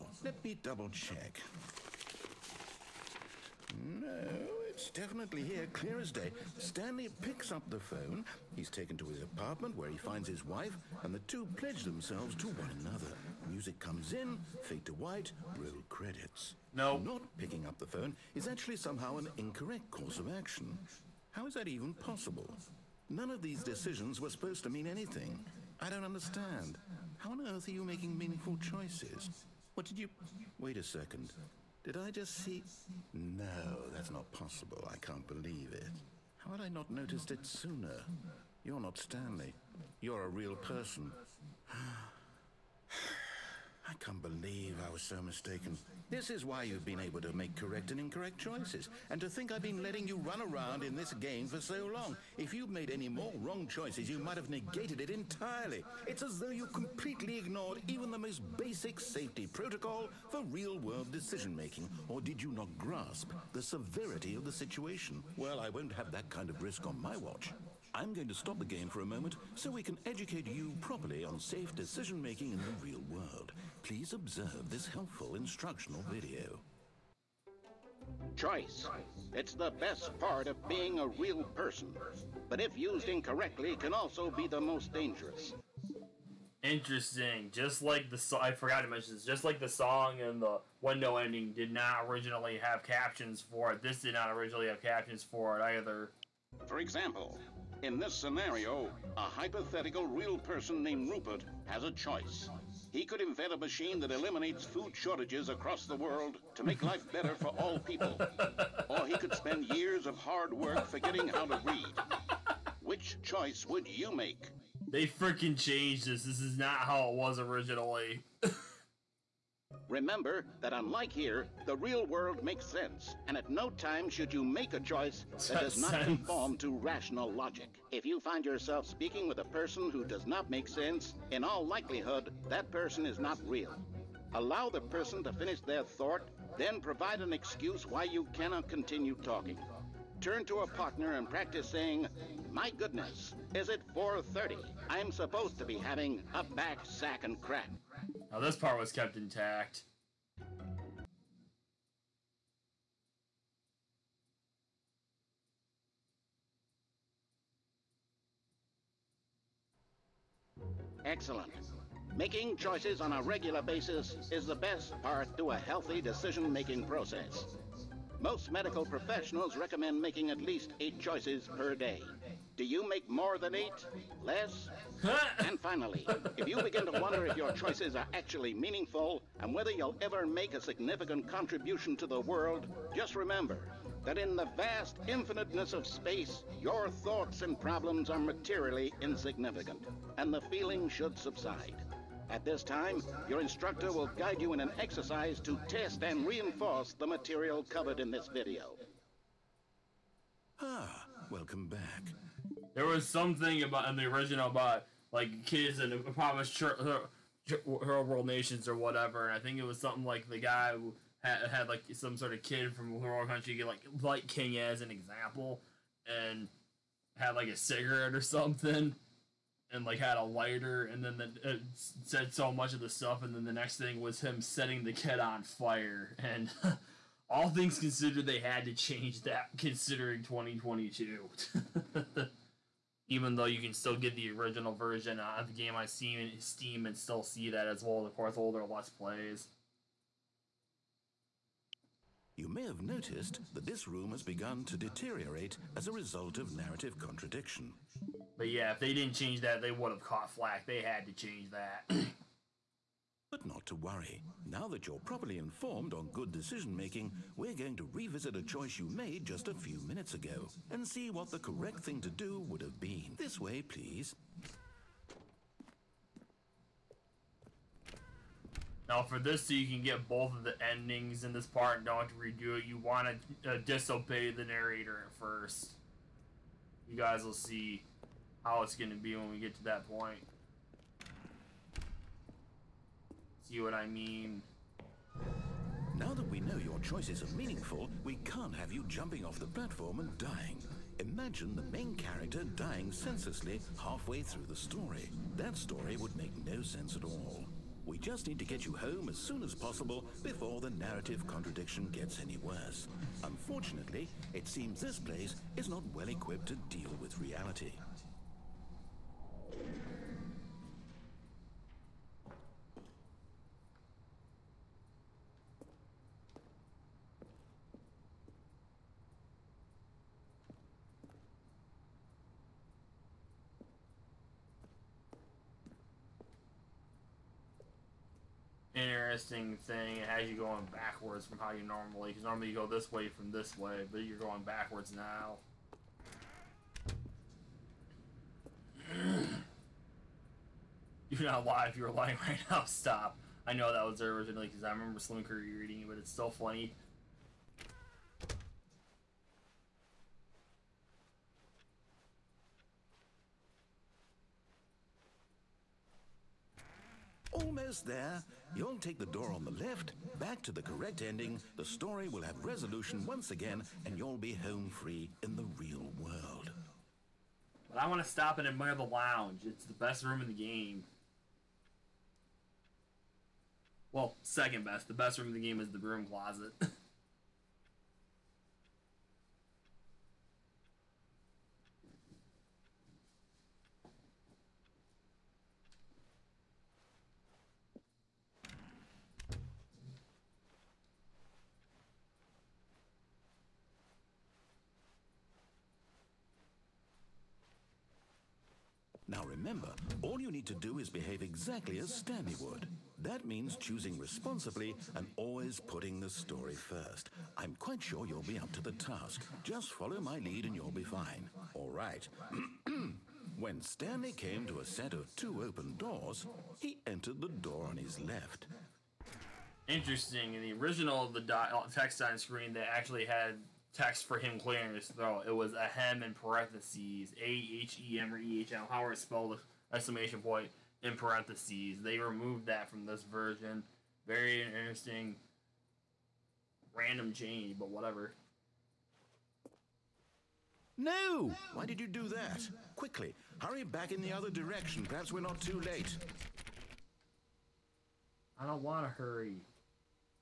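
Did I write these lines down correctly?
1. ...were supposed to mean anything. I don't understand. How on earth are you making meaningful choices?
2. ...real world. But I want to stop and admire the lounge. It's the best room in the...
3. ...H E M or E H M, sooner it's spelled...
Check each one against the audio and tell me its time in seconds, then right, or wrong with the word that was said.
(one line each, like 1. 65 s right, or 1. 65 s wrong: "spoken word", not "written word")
1. 24 s right
2. 365 s right
3. 427 s wrong: "however", not "sooner".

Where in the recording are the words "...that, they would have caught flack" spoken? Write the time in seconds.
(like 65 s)
249 s.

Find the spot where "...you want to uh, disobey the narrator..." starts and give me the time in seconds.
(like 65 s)
272 s.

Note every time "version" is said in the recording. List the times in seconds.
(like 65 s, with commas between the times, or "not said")
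234 s, 433 s.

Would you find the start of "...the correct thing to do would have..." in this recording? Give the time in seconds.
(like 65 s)
261 s.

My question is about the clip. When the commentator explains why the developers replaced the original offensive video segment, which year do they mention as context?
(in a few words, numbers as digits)
2022.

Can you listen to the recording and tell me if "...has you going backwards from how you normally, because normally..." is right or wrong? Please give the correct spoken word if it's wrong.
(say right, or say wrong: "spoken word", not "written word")
right.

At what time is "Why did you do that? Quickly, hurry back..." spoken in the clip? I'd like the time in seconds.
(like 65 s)
441 s.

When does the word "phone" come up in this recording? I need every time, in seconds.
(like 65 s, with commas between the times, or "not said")
7 s, 17 s.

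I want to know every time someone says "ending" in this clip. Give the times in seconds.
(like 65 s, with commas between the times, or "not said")
91 s, 270 s, 361 s.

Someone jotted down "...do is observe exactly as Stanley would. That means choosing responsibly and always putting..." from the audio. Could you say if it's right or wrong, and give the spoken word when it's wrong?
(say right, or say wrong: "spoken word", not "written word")
wrong: "behave", not "observe".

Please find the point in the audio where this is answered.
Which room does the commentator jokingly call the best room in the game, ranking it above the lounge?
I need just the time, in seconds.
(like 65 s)
375 s.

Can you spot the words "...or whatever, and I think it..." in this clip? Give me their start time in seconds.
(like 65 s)
208 s.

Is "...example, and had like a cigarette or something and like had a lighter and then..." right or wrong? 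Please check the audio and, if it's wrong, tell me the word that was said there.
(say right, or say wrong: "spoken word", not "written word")
right.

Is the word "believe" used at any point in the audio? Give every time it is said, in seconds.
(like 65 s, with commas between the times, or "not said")
35 s, 44 s.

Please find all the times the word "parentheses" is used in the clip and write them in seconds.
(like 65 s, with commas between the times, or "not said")
426 s, 430 s.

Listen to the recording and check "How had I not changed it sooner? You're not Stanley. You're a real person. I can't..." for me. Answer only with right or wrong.
wrong.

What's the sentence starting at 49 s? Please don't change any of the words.
And to think I've been letting you run around in this game for so long.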